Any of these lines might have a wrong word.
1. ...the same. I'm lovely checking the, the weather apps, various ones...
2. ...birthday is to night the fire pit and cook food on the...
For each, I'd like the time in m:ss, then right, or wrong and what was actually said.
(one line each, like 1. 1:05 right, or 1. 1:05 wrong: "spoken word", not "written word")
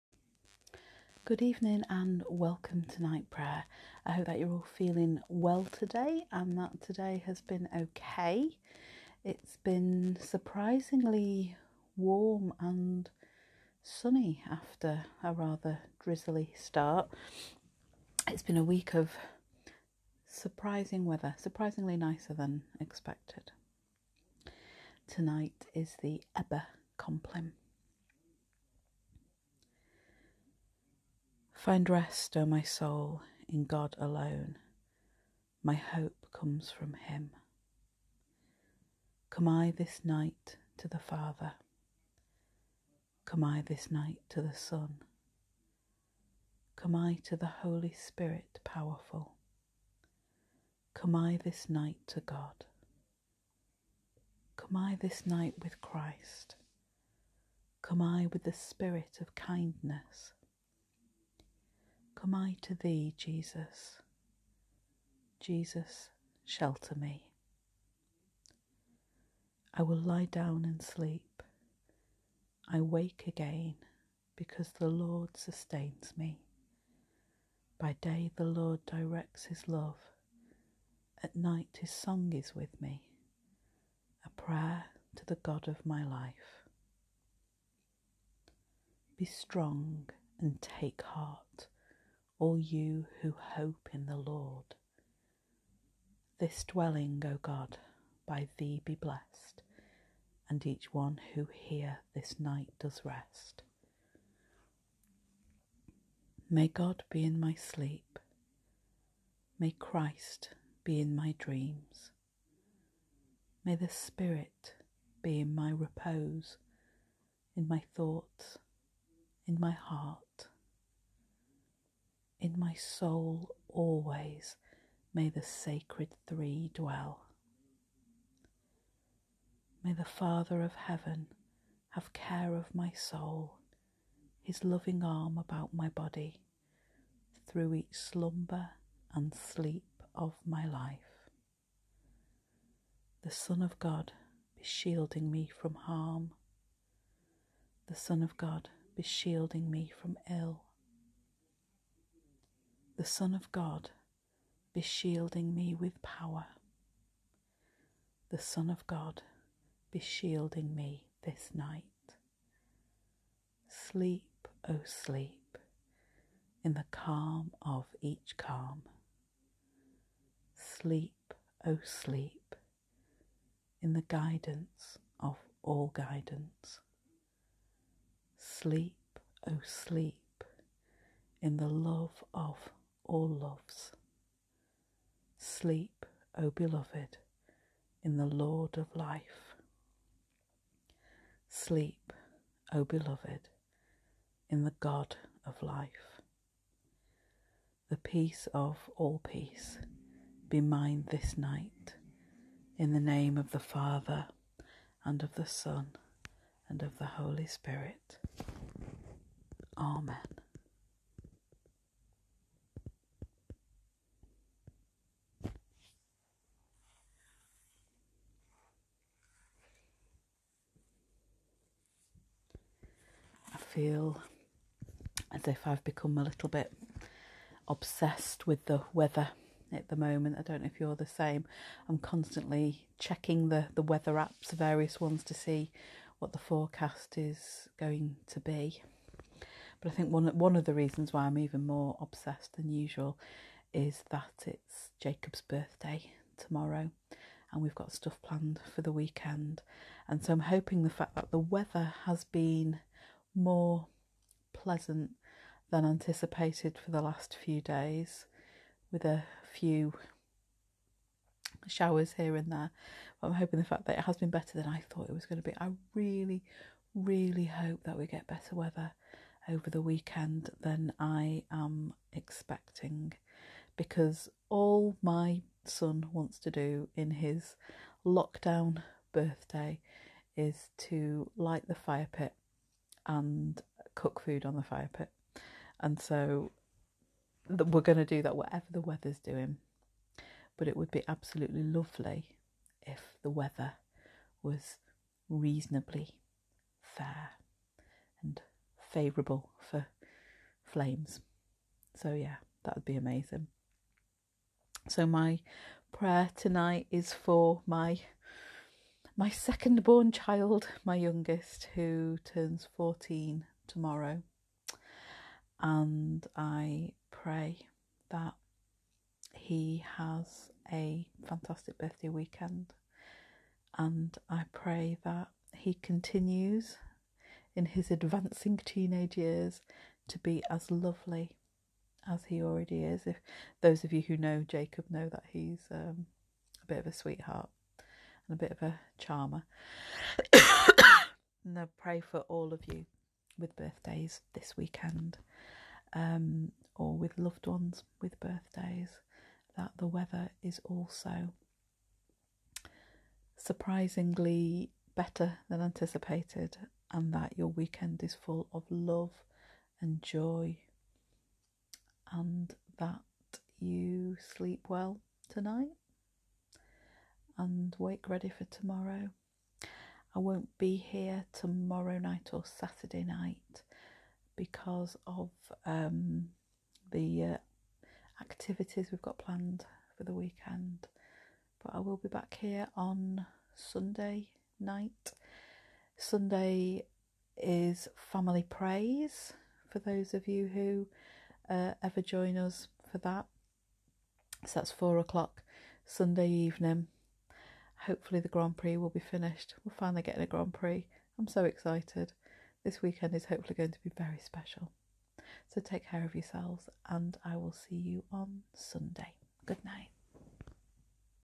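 1. 3:50 wrong: "constantly", not "lovely"
2. 4:39 wrong: "light", not "night".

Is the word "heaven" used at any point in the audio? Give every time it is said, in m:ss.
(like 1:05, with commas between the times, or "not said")
2:10.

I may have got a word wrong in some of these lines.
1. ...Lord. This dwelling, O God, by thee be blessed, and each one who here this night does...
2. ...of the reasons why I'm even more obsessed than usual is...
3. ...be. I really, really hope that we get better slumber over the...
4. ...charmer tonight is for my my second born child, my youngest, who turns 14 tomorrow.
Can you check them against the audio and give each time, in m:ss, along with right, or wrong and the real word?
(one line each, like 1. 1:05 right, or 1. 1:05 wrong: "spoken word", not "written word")
1. 1:34 right
2. 4:00 right
3. 4:25 wrong: "weather", not "slumber"
4. 5:05 wrong: "prayer", not "charmer".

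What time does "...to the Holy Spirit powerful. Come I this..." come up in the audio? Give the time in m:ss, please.
0:47.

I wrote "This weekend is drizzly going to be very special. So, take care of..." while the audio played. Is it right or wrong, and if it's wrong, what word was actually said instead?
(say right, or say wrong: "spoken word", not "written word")
wrong: "hopefully", not "drizzly".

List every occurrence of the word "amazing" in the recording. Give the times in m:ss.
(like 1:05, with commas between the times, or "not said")
5:02.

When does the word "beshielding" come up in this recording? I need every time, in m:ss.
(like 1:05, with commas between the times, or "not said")
2:34, 2:39.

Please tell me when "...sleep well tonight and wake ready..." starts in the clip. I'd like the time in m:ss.
6:04.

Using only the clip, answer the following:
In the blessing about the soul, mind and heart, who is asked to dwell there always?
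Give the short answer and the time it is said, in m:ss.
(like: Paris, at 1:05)
the sacred three, at 2:05.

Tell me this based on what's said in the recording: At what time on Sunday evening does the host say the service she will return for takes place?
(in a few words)
4 o'clock.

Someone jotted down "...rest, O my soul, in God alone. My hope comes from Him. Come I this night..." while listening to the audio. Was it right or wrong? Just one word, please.
right.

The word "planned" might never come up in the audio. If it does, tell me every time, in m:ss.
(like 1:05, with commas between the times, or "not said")
4:08, 6:19.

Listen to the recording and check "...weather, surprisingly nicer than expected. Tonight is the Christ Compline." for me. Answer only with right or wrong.
wrong.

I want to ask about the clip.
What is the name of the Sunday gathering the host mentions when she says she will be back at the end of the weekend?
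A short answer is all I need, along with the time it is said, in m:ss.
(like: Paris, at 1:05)
Family praise, at 6:27.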